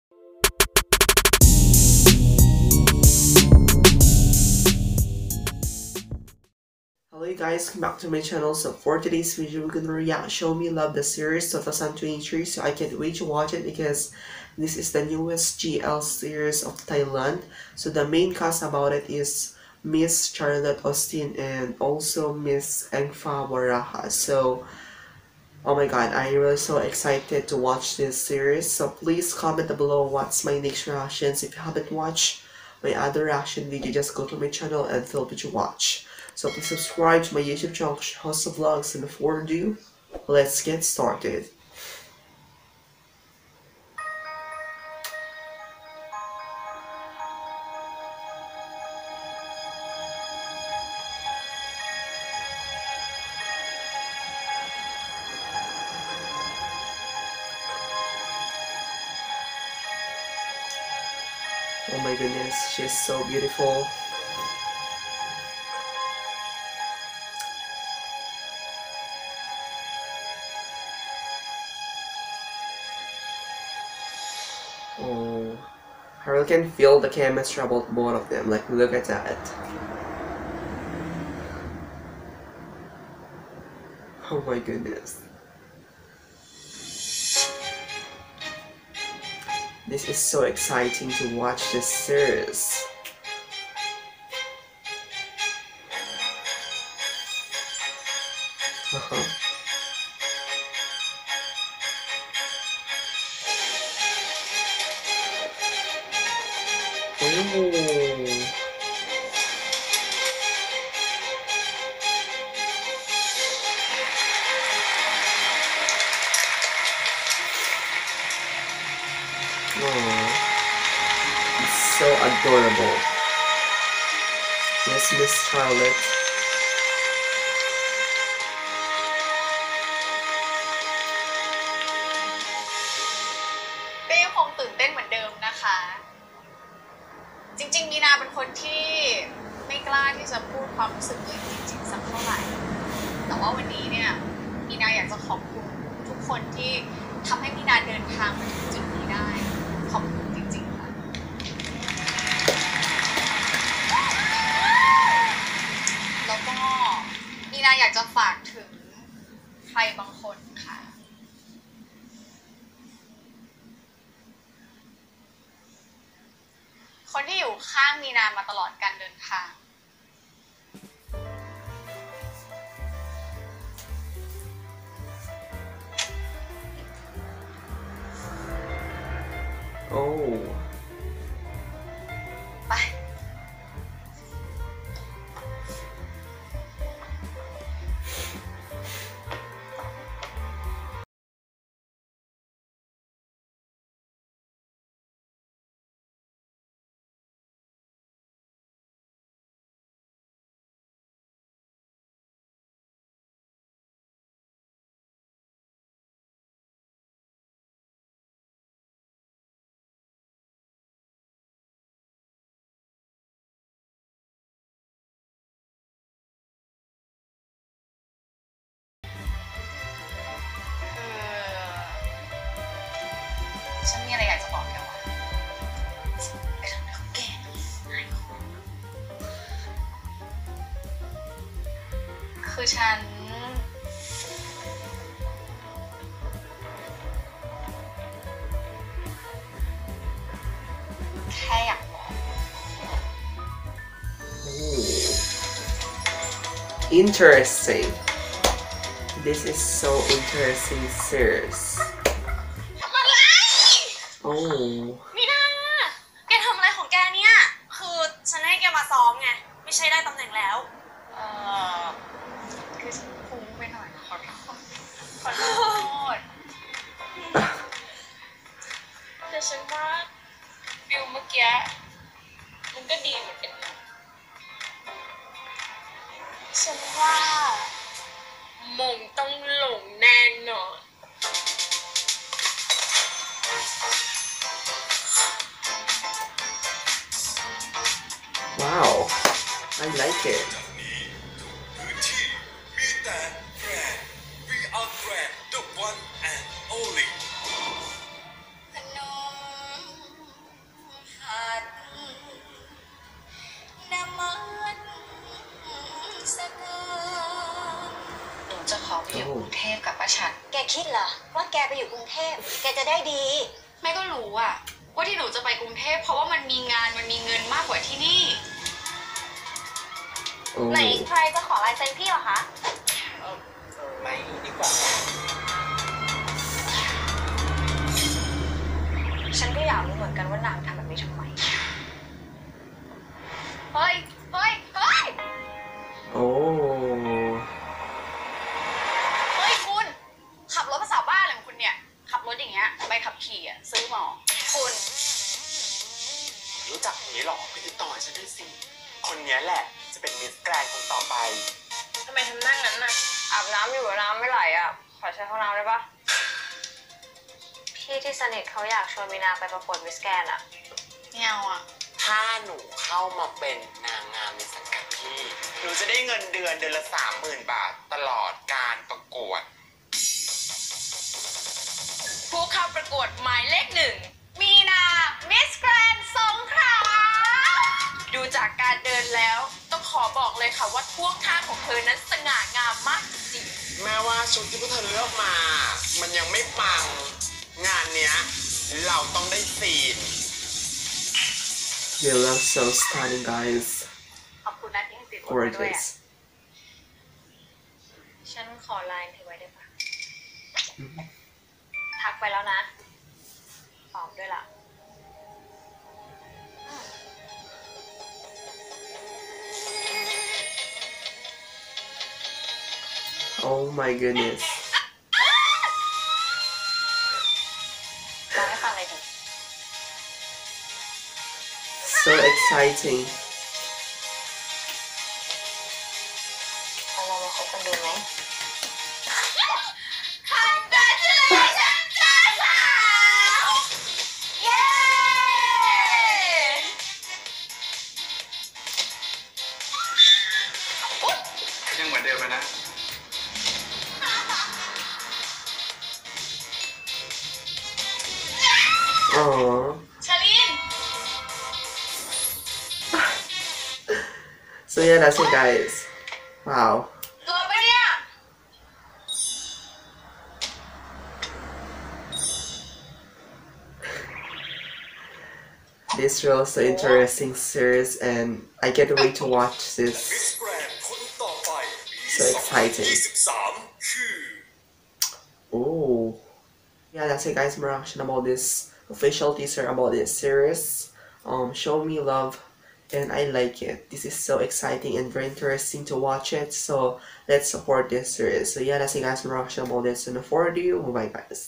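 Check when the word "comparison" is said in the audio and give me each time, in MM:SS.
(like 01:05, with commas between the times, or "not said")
not said.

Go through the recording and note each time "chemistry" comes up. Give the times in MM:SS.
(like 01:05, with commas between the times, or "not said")
01:17.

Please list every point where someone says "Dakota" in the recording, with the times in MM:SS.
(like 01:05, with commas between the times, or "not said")
not said.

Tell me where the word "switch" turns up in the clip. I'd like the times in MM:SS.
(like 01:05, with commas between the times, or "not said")
not said.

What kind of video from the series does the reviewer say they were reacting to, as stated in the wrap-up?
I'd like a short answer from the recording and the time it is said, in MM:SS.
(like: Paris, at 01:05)
official teaser, at 07:58.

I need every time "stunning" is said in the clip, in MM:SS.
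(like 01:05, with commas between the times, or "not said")
06:32.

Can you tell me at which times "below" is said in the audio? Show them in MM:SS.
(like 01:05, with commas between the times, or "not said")
00:29.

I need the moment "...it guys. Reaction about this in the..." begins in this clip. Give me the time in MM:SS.
08:08.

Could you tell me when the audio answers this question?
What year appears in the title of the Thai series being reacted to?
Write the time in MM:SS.
00:11.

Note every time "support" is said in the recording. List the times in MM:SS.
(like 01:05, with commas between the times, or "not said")
08:07.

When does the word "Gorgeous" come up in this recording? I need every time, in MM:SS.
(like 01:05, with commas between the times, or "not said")
06:35.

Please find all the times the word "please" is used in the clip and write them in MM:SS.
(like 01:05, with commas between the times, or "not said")
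00:28, 00:36.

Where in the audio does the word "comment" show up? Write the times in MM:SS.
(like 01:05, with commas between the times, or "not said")
00:29.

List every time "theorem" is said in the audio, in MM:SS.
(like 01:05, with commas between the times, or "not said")
not said.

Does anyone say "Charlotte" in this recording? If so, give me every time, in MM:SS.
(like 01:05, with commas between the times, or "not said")
00:20, 02:05.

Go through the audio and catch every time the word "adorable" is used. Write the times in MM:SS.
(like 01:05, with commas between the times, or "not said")
02:02.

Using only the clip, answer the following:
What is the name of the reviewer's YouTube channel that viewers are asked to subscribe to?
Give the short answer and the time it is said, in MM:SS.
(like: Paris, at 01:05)
Justo Vlogs, at 00:37.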